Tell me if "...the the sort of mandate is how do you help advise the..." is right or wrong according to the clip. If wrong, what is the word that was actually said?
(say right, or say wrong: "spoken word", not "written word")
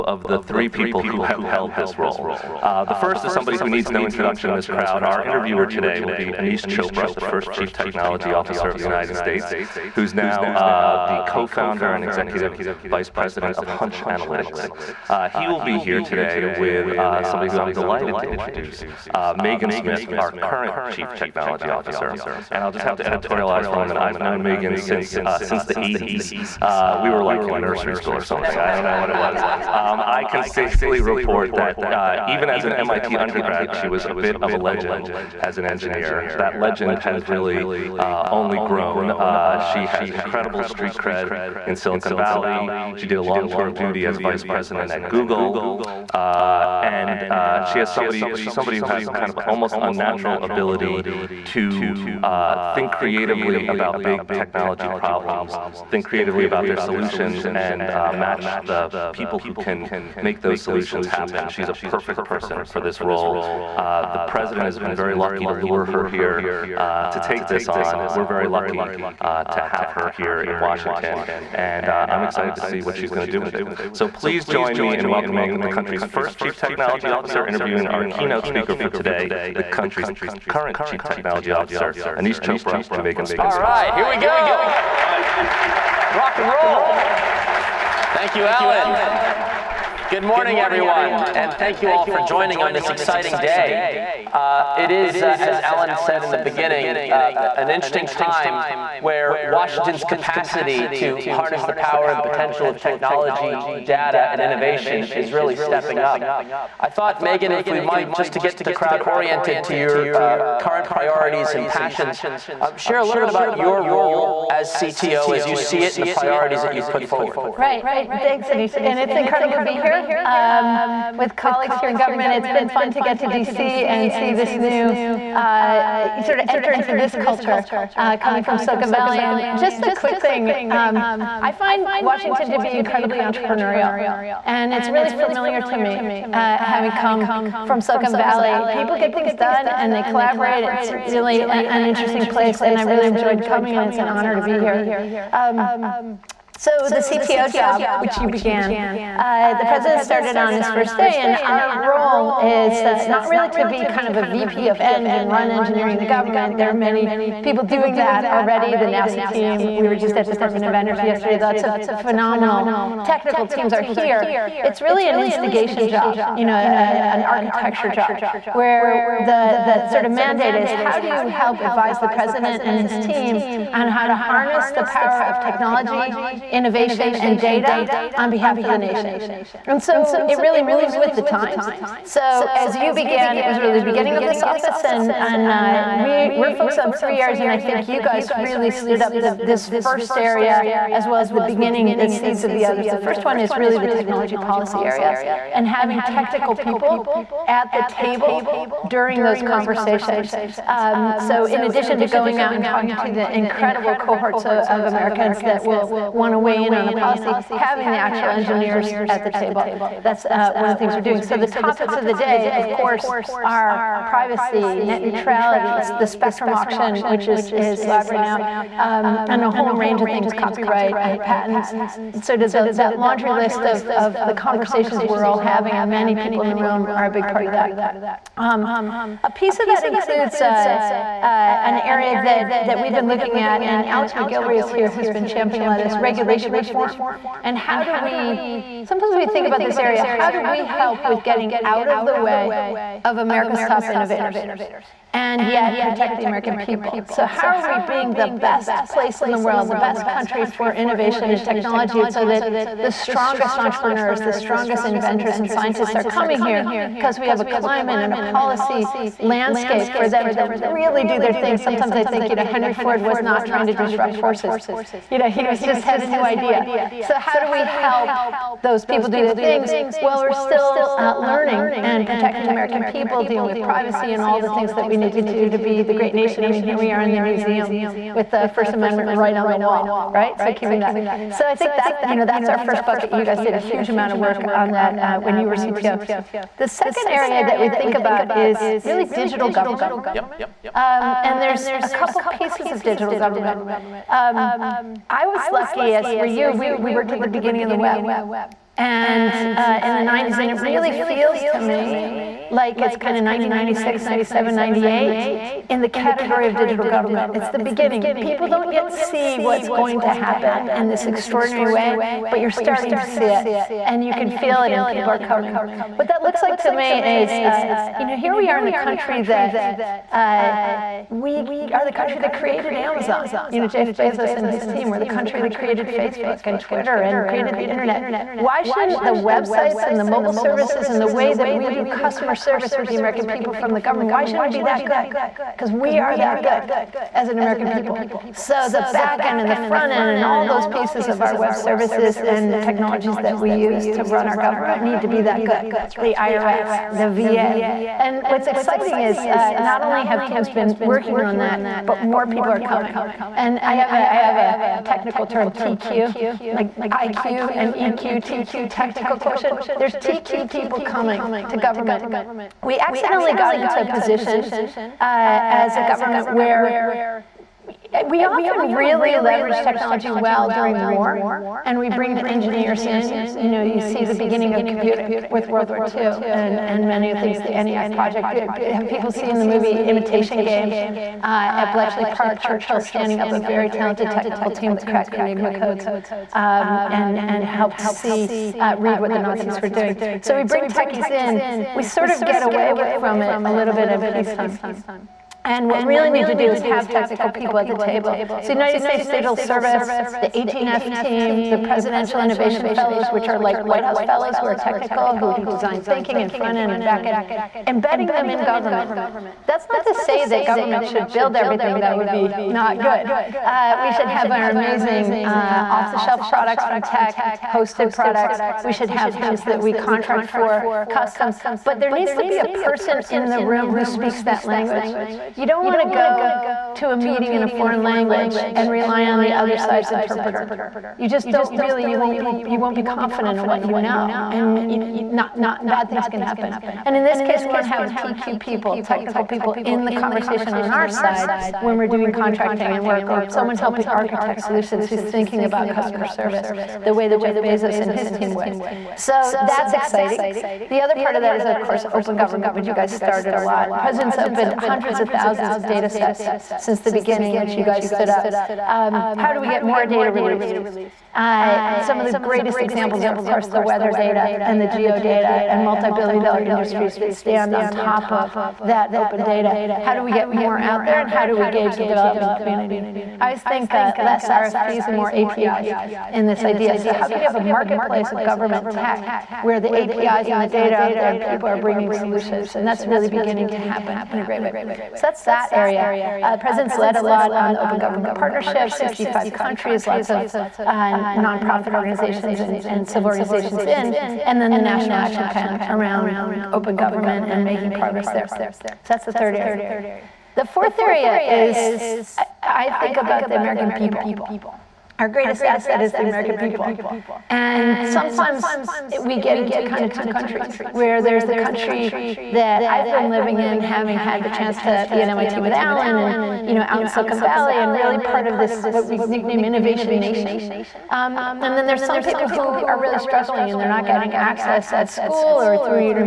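right.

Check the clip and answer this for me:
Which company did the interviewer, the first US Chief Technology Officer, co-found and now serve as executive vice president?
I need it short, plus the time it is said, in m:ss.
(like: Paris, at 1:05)
Hunch Analytics, at 0:13.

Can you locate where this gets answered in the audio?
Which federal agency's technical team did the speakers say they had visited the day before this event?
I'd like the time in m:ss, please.
2:40.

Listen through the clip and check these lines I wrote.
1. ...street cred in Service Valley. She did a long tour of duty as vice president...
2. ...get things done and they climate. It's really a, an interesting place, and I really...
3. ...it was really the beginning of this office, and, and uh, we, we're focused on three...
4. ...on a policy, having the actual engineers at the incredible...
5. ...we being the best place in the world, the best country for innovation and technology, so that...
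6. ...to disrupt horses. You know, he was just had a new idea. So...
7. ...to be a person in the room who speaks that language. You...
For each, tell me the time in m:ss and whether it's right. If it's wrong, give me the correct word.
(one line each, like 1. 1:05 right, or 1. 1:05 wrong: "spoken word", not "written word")
1. 0:40 wrong: "Silicon", not "Service"
2. 2:18 wrong: "collaborate", not "climate"
3. 3:03 right
4. 3:26 wrong: "table", not "incredible"
5. 4:07 right
6. 4:23 right
7. 7:02 right.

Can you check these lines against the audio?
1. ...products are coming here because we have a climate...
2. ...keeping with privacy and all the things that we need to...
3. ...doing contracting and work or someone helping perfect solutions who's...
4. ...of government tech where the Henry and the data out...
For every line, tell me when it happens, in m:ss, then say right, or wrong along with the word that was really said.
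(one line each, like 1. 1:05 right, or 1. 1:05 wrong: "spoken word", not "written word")
1. 4:15 wrong: "scientists", not "products"
2. 4:33 wrong: "dealing", not "keeping"
3. 7:21 wrong: "architect", not "perfect"
4. 7:58 wrong: "APIs", not "Henry".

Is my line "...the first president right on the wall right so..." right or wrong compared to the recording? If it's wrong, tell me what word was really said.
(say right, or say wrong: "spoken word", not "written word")
wrong: "amendment", not "president".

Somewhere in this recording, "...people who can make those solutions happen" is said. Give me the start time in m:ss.
0:59.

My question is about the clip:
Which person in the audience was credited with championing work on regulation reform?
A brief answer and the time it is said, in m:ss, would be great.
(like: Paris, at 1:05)
Alex Macgillivray, at 3:53.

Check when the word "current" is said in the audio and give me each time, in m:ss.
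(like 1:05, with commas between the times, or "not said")
0:20, 1:20, 1:50.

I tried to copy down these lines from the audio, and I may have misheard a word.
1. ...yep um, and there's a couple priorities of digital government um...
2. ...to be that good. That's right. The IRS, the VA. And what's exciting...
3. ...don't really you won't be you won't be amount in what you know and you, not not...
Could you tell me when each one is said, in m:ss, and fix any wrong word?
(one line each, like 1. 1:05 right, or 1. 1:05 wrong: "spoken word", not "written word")
1. 4:50 wrong: "pieces", not "priorities"
2. 5:45 right
3. 7:11 wrong: "confident", not "amount".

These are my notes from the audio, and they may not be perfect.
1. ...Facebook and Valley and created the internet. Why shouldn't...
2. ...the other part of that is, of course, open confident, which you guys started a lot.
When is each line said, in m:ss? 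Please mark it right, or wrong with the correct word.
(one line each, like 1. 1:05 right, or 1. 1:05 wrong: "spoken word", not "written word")
1. 5:25 wrong: "Twitter", not "Valley"
2. 7:30 wrong: "government", not "confident".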